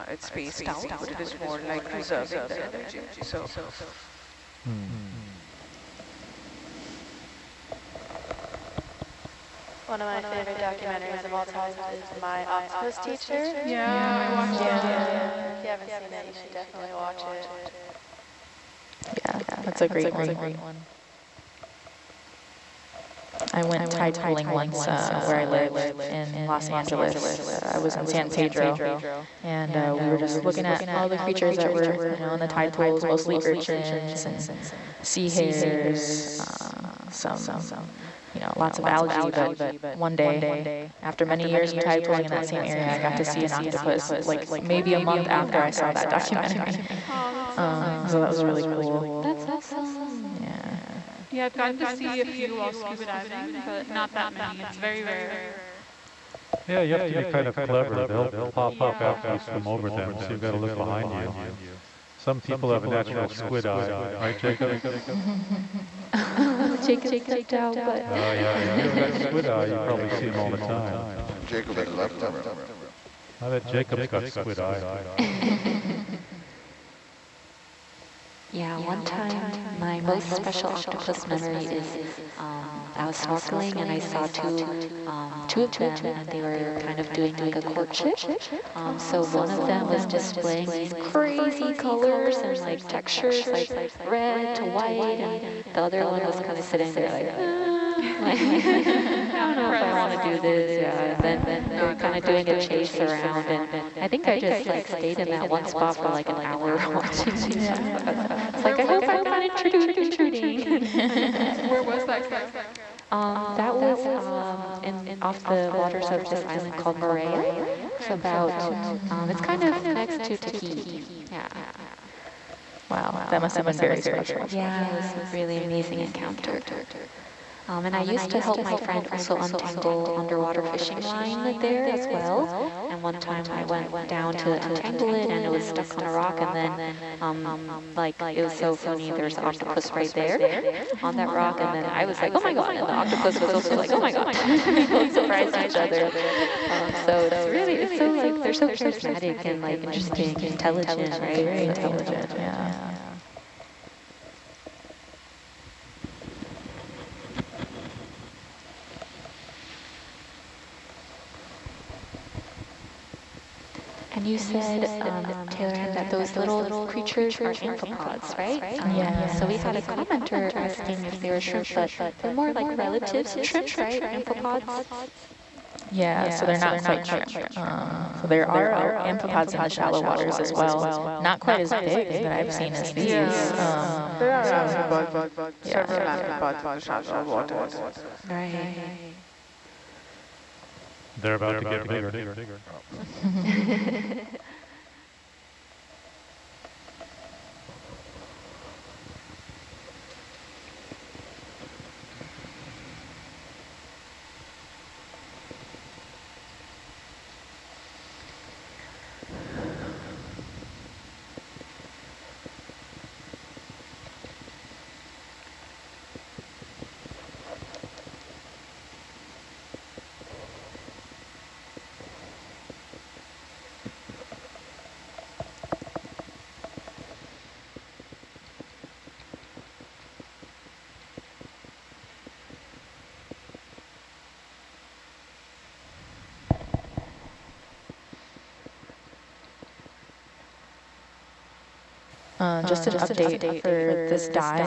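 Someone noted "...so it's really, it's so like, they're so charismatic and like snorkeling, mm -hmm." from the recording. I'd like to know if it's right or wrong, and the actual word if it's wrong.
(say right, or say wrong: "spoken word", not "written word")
wrong: "interesting", not "snorkeling".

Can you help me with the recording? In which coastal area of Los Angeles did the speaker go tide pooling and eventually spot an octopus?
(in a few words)
San Pedro.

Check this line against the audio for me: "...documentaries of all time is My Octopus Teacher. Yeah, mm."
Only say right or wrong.
right.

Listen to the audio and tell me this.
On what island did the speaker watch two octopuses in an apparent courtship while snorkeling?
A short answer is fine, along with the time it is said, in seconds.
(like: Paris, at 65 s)
Moorea, at 116 s.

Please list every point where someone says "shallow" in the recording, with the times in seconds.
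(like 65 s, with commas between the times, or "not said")
179 s, 186 s.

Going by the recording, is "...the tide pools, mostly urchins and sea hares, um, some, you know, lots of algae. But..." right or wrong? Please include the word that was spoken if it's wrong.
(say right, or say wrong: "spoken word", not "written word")
right.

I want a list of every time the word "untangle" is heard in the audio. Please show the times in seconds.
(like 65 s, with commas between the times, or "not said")
129 s, 134 s.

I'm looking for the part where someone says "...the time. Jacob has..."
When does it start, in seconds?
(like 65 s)
70 s.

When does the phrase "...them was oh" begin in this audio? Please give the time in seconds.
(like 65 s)
89 s.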